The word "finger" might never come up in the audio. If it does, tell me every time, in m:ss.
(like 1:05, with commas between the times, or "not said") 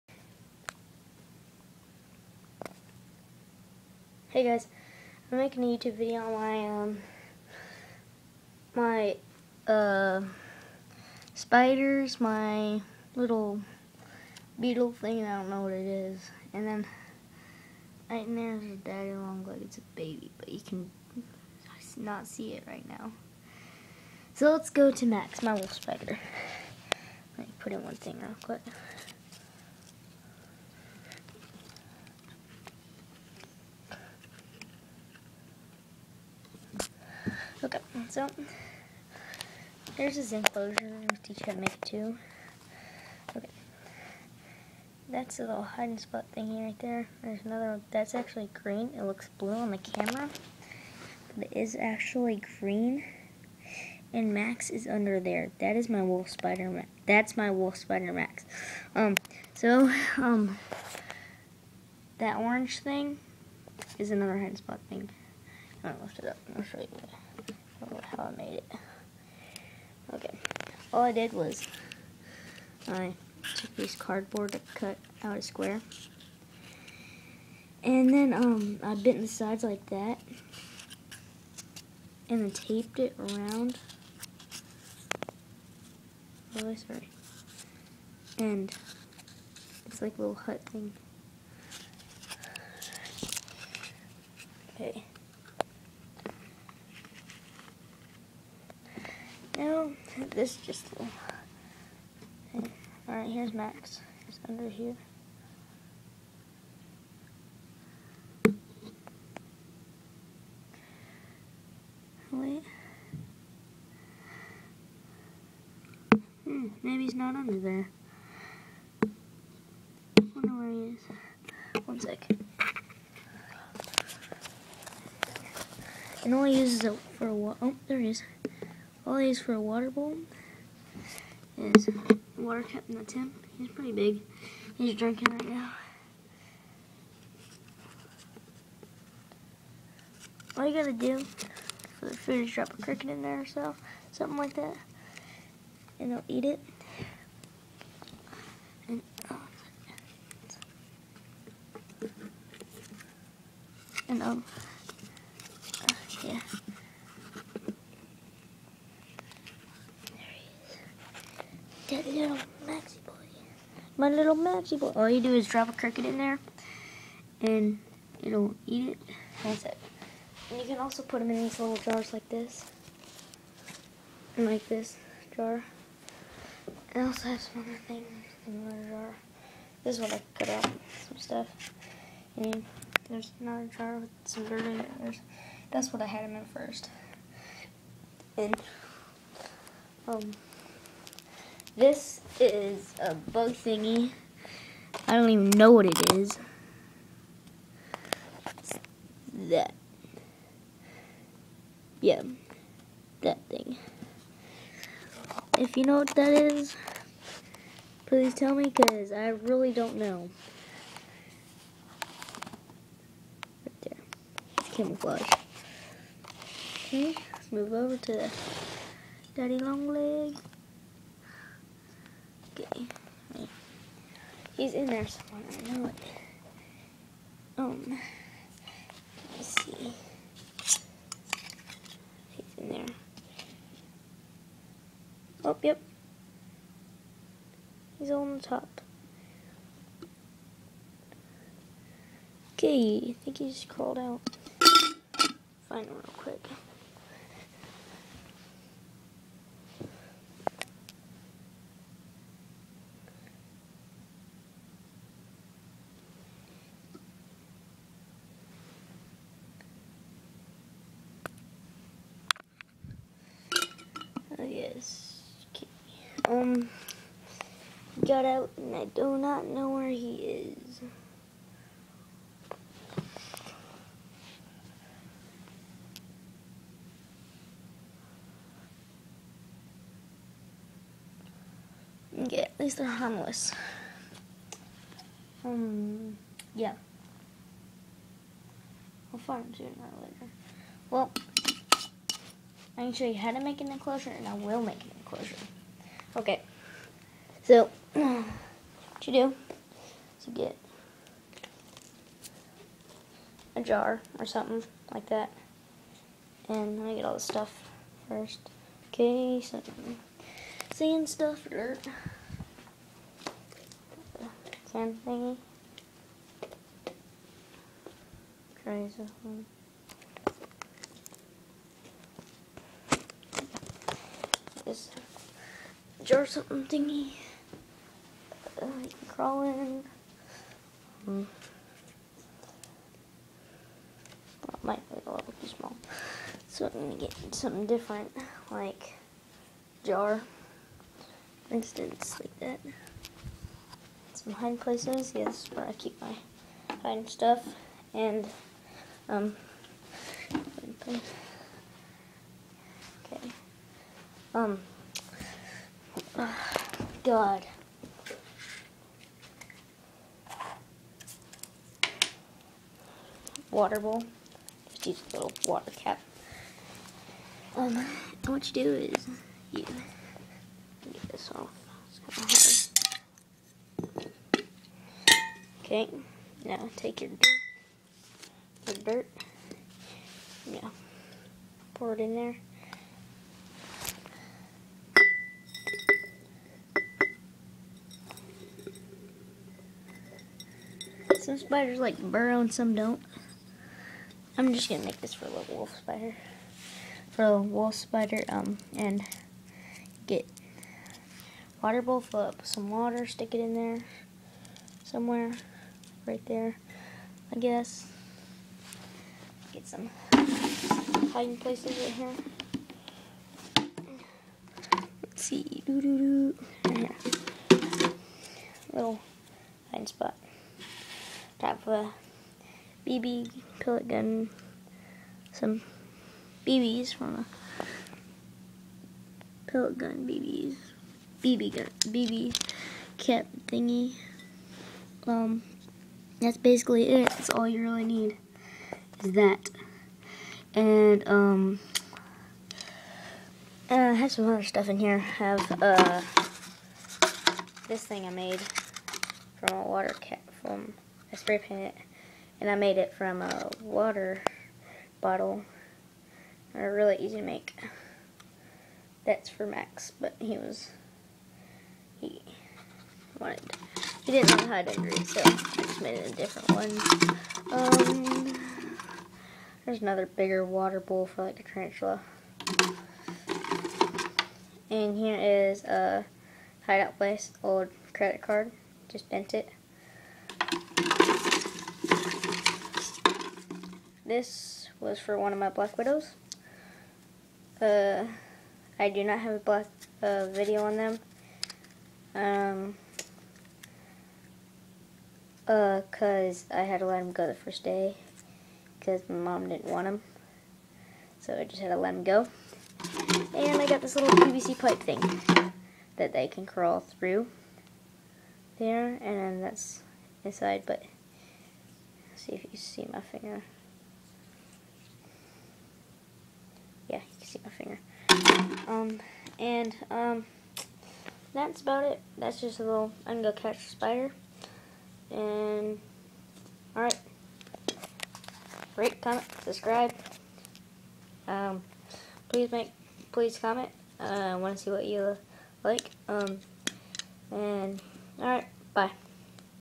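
8:32, 8:37.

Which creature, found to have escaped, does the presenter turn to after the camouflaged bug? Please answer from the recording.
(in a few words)
Daddy Longlegs.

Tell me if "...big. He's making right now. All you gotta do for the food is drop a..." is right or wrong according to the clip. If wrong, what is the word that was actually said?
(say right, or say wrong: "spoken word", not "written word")
wrong: "drinking", not "making".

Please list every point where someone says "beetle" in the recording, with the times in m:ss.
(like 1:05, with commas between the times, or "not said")
0:14.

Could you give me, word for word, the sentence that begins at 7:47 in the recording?
Um, there's another bigger water bowl for like a tarantula.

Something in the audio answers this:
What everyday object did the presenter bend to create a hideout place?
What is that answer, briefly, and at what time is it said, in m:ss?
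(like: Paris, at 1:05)
Old credit card, at 7:57.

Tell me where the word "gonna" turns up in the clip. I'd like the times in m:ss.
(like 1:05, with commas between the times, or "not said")
5:36, 6:34.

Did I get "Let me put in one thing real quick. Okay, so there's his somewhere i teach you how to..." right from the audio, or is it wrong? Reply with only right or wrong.
wrong.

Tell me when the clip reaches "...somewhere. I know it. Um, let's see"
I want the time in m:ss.
3:45.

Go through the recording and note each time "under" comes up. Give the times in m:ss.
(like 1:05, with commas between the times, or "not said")
0:54, 1:44, 1:57.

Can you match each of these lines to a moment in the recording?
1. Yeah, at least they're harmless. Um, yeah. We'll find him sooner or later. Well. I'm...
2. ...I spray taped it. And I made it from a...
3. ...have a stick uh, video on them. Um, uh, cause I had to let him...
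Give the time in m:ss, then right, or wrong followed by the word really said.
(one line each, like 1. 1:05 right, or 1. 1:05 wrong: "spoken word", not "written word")
1. 4:42 right
2. 7:31 wrong: "painted", not "taped"
3. 8:09 wrong: "black", not "stick".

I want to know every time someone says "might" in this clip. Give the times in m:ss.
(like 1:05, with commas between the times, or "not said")
5:34.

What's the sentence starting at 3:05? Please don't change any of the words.
There's, that's what I had them in first.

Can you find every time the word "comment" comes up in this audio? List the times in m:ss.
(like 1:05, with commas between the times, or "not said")
8:49, 8:53.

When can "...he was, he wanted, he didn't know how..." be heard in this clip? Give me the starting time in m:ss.
7:40.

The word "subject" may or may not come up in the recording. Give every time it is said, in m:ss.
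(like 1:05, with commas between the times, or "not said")
not said.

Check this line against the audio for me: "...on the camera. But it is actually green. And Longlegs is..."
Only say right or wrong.
wrong.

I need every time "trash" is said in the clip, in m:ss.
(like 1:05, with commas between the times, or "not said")
not said.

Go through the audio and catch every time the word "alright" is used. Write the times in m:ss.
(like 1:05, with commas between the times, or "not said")
1:43, 8:46, 8:58.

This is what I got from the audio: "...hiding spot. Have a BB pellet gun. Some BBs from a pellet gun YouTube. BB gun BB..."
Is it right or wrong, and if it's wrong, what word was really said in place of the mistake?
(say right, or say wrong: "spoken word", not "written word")
wrong: "BBs", not "YouTube".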